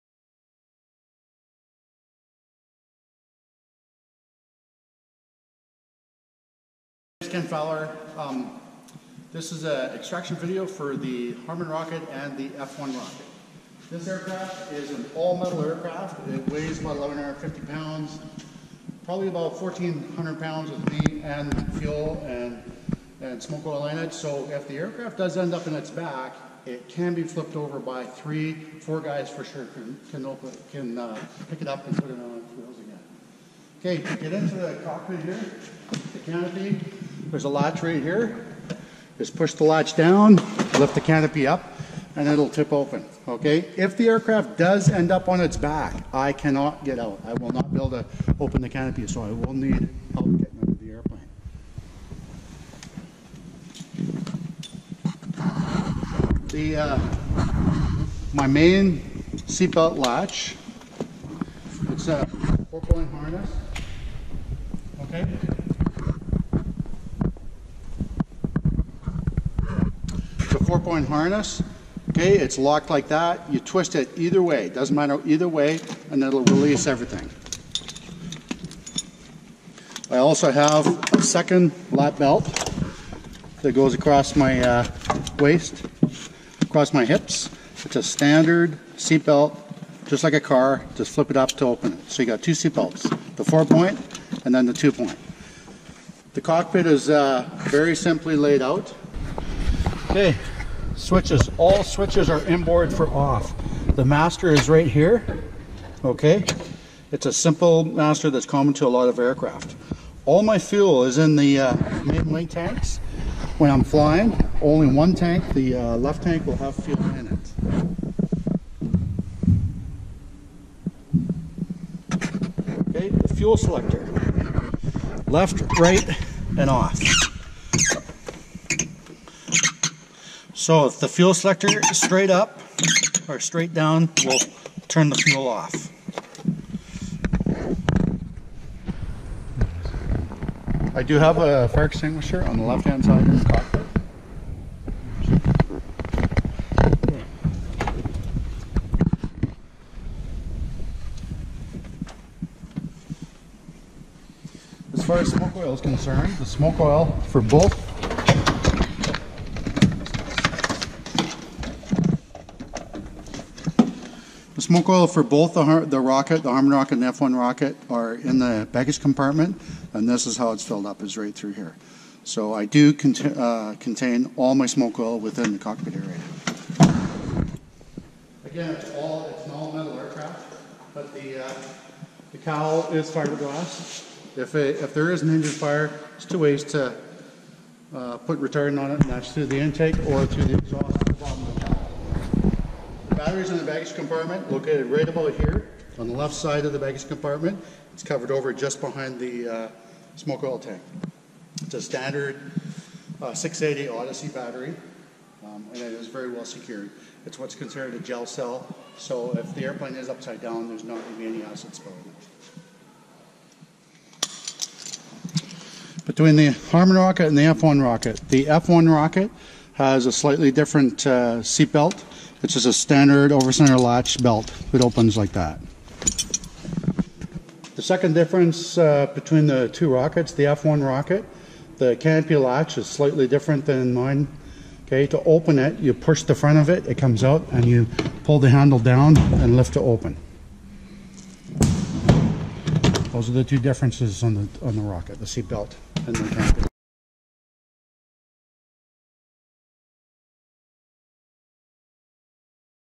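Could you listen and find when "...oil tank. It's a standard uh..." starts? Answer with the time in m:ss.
3:20.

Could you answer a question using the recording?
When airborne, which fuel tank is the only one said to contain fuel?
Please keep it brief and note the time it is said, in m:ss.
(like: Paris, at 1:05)
left tank, at 1:55.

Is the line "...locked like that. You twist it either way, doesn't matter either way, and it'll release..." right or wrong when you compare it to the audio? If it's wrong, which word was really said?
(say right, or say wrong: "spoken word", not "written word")
right.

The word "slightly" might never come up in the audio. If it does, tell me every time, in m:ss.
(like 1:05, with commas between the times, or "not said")
3:40, 3:52.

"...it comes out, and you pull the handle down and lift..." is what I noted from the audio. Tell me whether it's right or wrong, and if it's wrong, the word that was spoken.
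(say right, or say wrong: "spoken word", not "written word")
right.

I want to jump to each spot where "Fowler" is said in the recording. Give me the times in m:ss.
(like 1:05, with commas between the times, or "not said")
0:07.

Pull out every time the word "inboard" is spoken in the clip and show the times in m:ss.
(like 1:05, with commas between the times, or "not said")
1:42.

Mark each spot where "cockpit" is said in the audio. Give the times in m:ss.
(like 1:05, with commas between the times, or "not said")
0:34, 1:36, 2:23, 2:55.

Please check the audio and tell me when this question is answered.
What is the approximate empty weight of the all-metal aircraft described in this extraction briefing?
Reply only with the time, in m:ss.
0:16.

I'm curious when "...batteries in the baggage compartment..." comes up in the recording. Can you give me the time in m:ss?
3:13.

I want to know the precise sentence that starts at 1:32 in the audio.
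So you got two seat belts, the four point and then the two point.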